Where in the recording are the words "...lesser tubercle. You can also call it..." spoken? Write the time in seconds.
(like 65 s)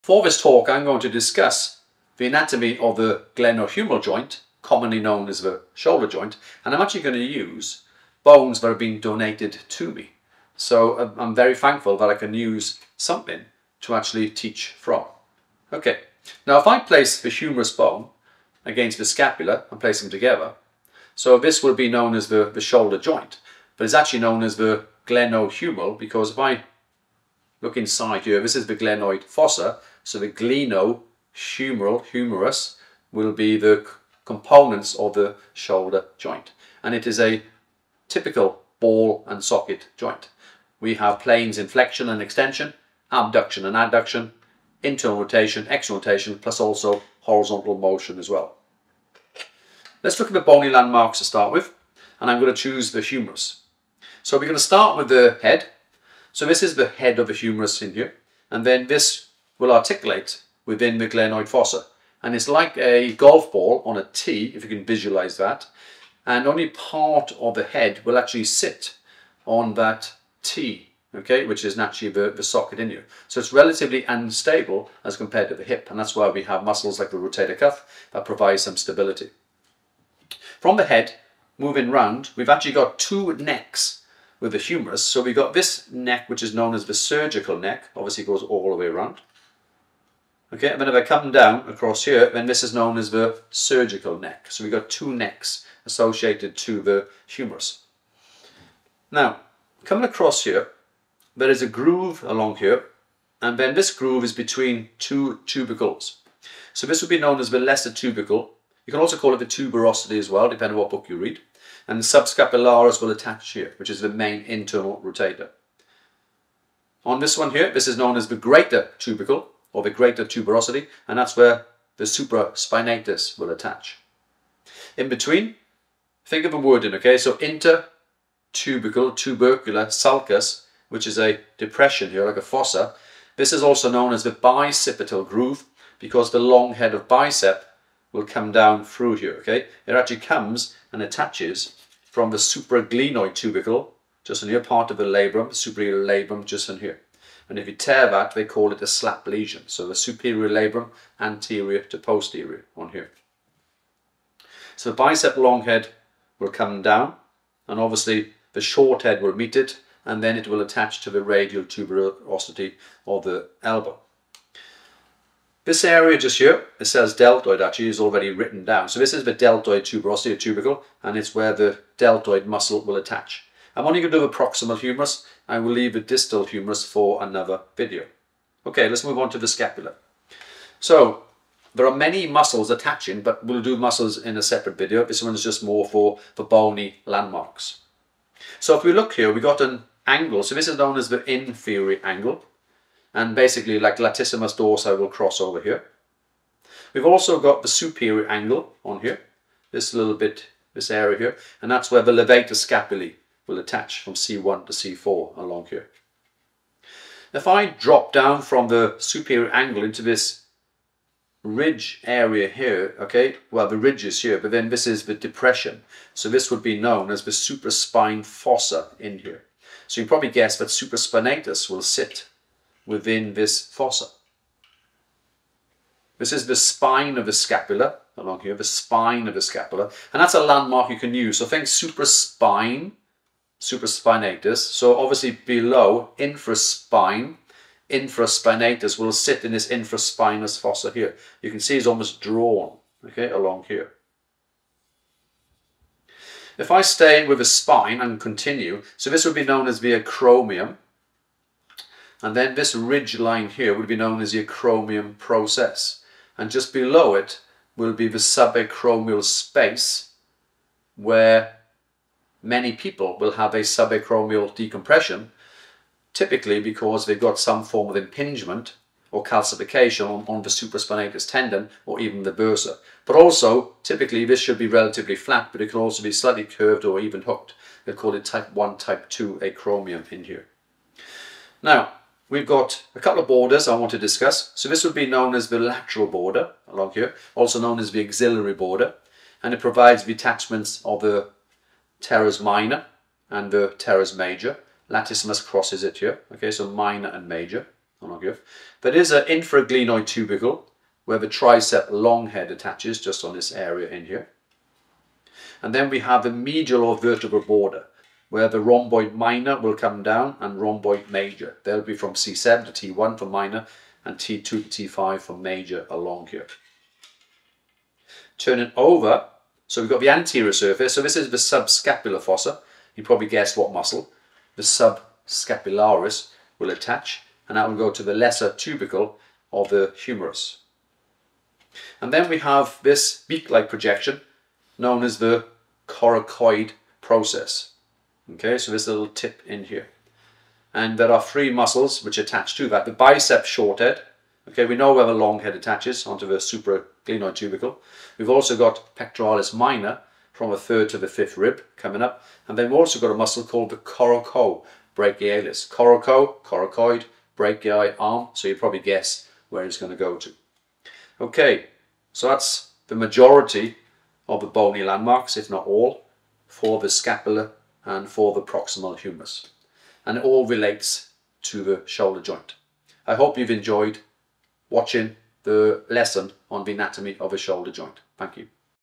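107 s.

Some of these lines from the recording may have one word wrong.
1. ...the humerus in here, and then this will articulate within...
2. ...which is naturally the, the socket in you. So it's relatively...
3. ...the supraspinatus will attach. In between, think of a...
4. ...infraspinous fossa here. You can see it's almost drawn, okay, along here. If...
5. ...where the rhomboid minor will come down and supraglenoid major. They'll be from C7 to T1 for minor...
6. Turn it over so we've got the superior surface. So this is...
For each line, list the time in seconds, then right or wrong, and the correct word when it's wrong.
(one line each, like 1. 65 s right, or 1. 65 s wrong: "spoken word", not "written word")
1. 57 s right
2. 71 s right
3. 121 s right
4. 239 s right
5. 308 s wrong: "rhomboid", not "supraglenoid"
6. 318 s wrong: "anterior", not "superior".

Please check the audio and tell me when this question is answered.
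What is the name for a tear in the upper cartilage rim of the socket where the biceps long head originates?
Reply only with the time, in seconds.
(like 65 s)
148 s.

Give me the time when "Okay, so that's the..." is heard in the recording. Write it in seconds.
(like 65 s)
361 s.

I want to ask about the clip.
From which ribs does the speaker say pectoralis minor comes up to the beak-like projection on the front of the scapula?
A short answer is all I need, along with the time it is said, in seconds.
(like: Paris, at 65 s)
third to the fifth, at 350 s.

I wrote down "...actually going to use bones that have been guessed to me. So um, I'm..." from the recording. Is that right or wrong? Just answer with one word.
wrong.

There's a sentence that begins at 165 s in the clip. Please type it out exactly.
This area just here, it says deltoid actually, is already written down.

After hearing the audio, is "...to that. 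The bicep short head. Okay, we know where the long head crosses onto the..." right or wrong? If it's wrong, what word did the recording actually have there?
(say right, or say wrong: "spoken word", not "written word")
wrong: "attaches", not "crosses".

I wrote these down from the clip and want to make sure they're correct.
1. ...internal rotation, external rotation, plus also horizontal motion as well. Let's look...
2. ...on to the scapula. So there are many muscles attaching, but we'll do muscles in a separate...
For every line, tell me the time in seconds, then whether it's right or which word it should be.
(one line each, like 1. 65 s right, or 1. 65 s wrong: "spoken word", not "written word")
1. 44 s right
2. 179 s right.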